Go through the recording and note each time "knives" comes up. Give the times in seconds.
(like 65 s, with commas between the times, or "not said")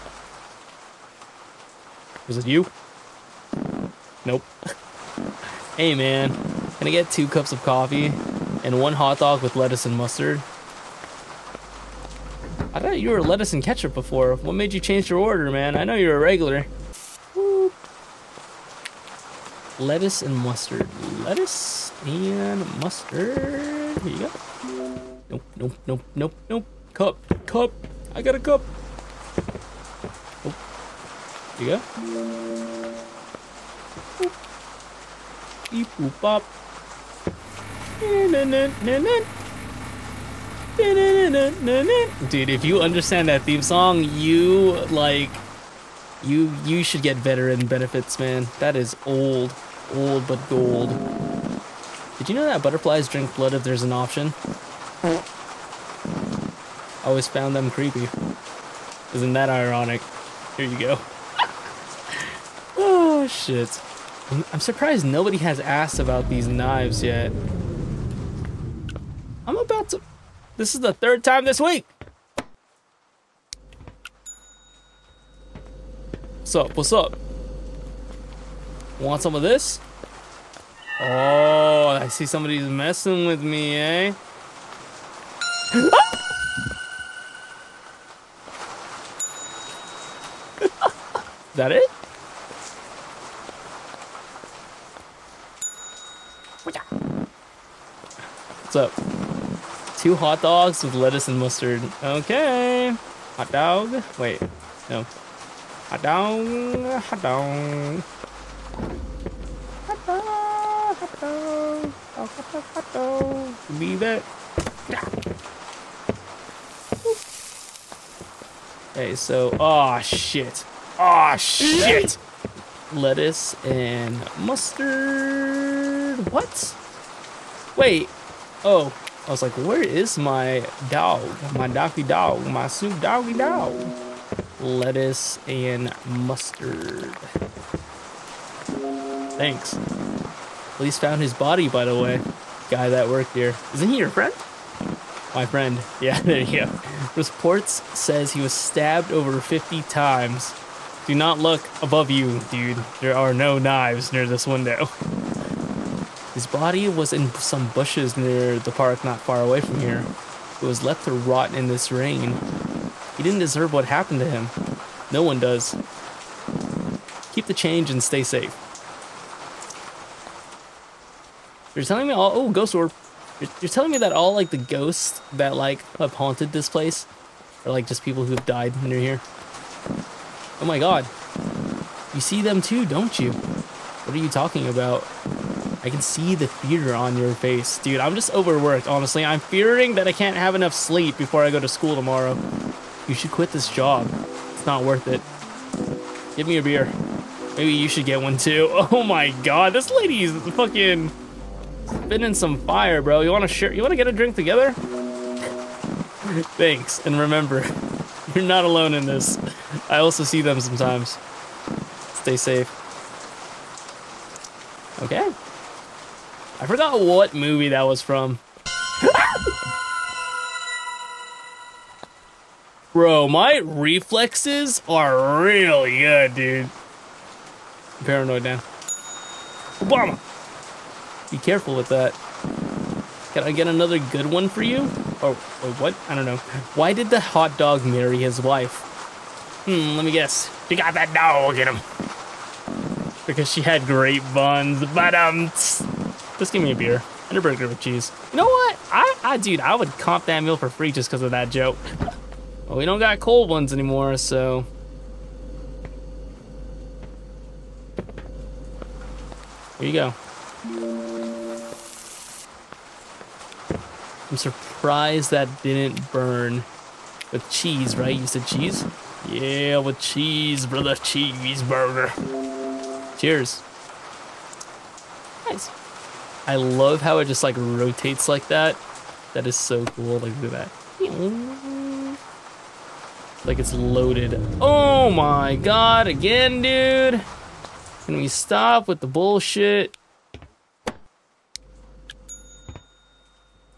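66 s, 153 s.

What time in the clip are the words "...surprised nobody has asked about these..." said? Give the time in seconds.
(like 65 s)
64 s.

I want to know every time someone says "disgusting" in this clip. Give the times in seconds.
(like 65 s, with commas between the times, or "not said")
not said.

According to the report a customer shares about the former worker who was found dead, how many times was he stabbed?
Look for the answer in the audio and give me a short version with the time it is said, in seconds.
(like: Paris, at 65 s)
over 50, at 149 s.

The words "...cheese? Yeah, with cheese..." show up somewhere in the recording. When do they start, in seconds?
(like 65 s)
268 s.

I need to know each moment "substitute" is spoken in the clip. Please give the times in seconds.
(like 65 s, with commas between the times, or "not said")
not said.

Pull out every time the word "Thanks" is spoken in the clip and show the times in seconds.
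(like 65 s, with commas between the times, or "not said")
139 s, 206 s.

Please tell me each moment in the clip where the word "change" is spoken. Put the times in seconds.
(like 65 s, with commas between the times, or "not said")
14 s, 167 s.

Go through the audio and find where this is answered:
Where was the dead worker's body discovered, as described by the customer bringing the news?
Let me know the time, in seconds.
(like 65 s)
157 s.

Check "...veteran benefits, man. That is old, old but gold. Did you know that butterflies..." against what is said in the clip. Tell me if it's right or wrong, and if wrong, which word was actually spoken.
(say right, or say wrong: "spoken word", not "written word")
right.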